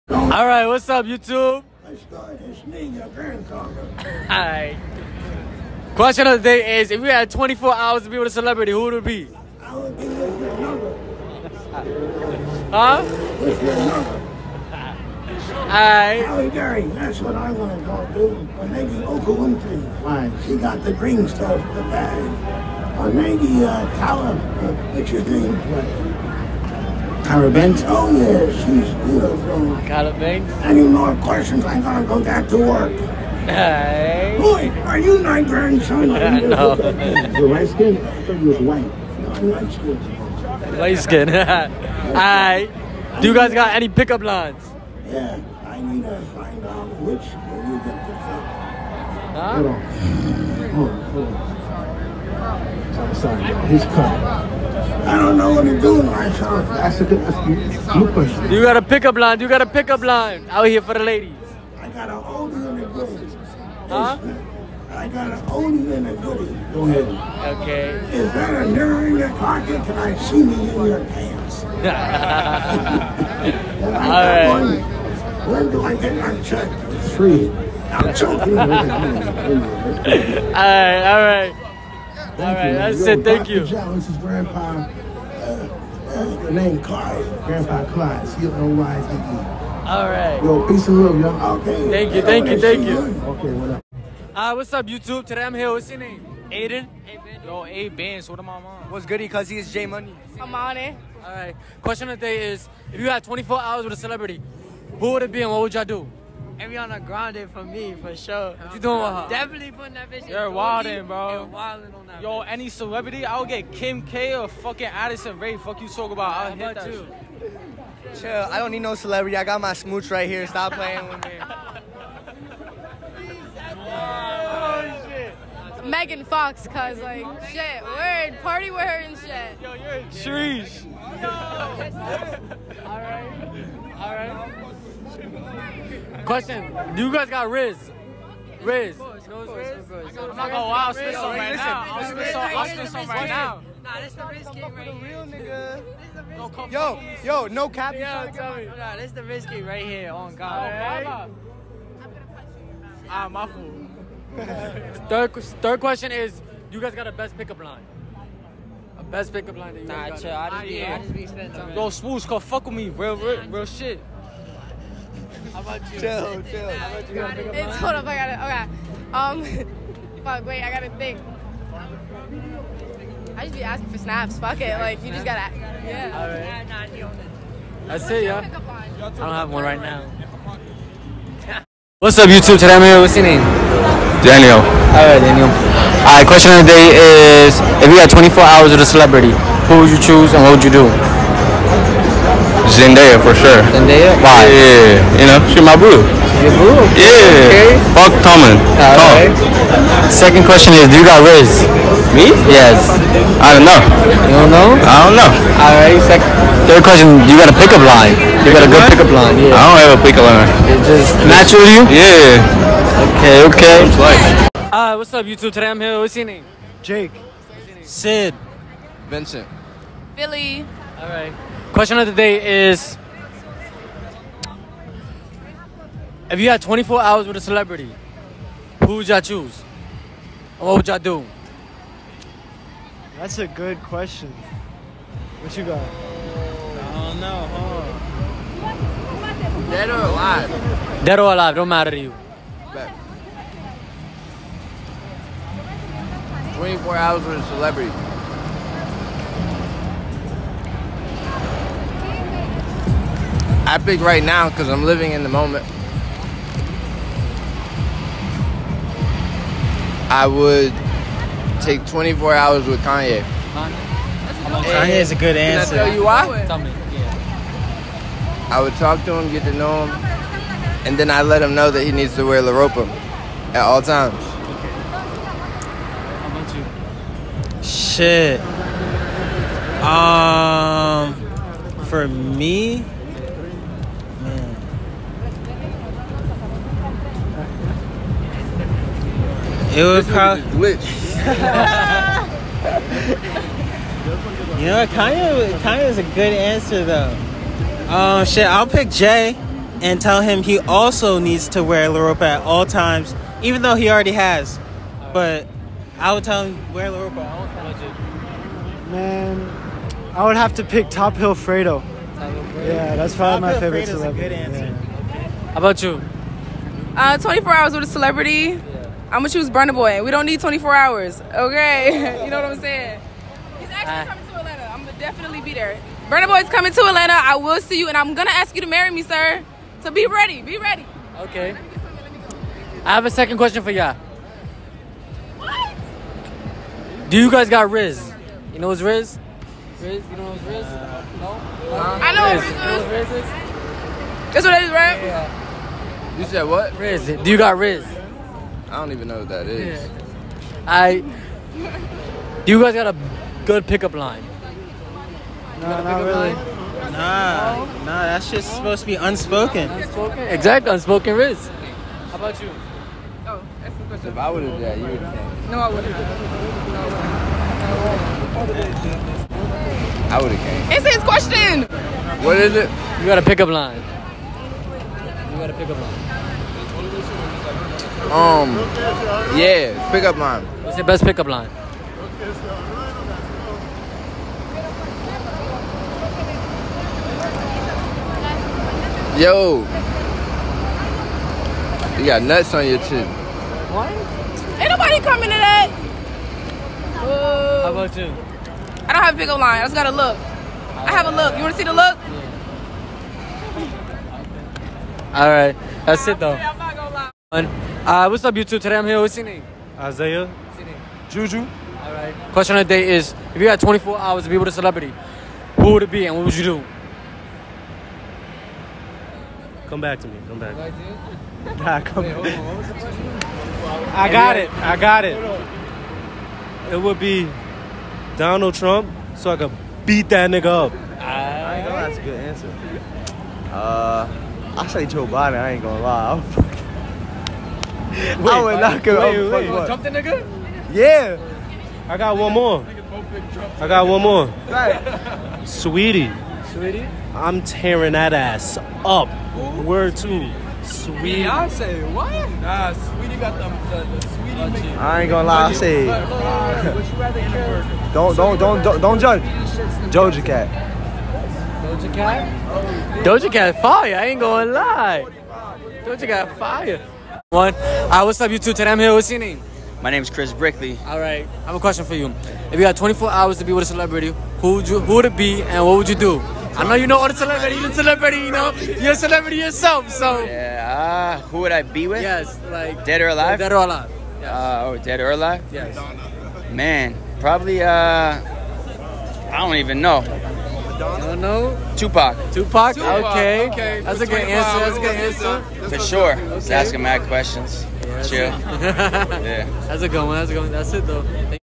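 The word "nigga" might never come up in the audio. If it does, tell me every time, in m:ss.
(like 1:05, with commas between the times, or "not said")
2:26, 7:10, 7:19.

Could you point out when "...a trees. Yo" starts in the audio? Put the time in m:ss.
2:09.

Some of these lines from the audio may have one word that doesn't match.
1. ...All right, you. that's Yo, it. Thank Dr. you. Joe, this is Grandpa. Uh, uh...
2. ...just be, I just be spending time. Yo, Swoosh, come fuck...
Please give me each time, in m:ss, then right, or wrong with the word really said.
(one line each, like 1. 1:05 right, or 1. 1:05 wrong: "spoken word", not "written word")
1. 1:22 right
2. 2:40 right.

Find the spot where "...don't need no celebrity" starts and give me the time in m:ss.
1:58.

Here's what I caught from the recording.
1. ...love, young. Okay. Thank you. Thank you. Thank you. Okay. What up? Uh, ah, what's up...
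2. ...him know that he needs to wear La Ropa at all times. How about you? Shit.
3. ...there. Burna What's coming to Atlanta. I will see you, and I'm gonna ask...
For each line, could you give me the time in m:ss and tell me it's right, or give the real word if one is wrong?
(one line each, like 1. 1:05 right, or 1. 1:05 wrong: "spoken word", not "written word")
1. 1:31 right
2. 4:31 right
3. 5:25 wrong: "Boy", not "What".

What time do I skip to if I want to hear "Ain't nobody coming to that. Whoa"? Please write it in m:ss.
6:34.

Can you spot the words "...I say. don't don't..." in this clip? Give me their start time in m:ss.
7:35.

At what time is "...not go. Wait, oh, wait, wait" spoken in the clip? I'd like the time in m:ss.
7:18.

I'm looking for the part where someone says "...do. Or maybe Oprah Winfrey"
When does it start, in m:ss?
0:18.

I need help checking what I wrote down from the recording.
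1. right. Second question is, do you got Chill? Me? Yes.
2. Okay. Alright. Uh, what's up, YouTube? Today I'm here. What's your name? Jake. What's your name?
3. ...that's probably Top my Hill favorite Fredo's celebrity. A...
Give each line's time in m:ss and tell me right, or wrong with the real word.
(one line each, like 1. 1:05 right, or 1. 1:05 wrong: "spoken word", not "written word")
1. 3:19 wrong: "Riz", not "Chill"
2. 3:33 right
3. 5:12 right.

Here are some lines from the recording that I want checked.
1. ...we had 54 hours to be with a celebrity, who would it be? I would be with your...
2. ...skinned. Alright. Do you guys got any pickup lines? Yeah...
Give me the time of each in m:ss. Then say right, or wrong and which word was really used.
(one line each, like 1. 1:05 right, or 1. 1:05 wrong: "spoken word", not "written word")
1. 0:07 wrong: "24", not "54"
2. 0:41 right.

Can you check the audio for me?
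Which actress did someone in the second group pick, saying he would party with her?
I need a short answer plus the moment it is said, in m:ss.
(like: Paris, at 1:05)
Megan Fox, at 2:05.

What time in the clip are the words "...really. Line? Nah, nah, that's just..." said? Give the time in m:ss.
5:56.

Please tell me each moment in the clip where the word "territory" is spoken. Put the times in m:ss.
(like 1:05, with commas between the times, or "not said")
not said.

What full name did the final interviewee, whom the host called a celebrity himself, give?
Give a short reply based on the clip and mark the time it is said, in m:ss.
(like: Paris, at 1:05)
Chris Brickley, at 7:50.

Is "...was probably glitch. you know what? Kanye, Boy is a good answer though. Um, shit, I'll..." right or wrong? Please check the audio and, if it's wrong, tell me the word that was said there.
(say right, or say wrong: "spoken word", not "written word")
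wrong: "Kanye", not "Boy".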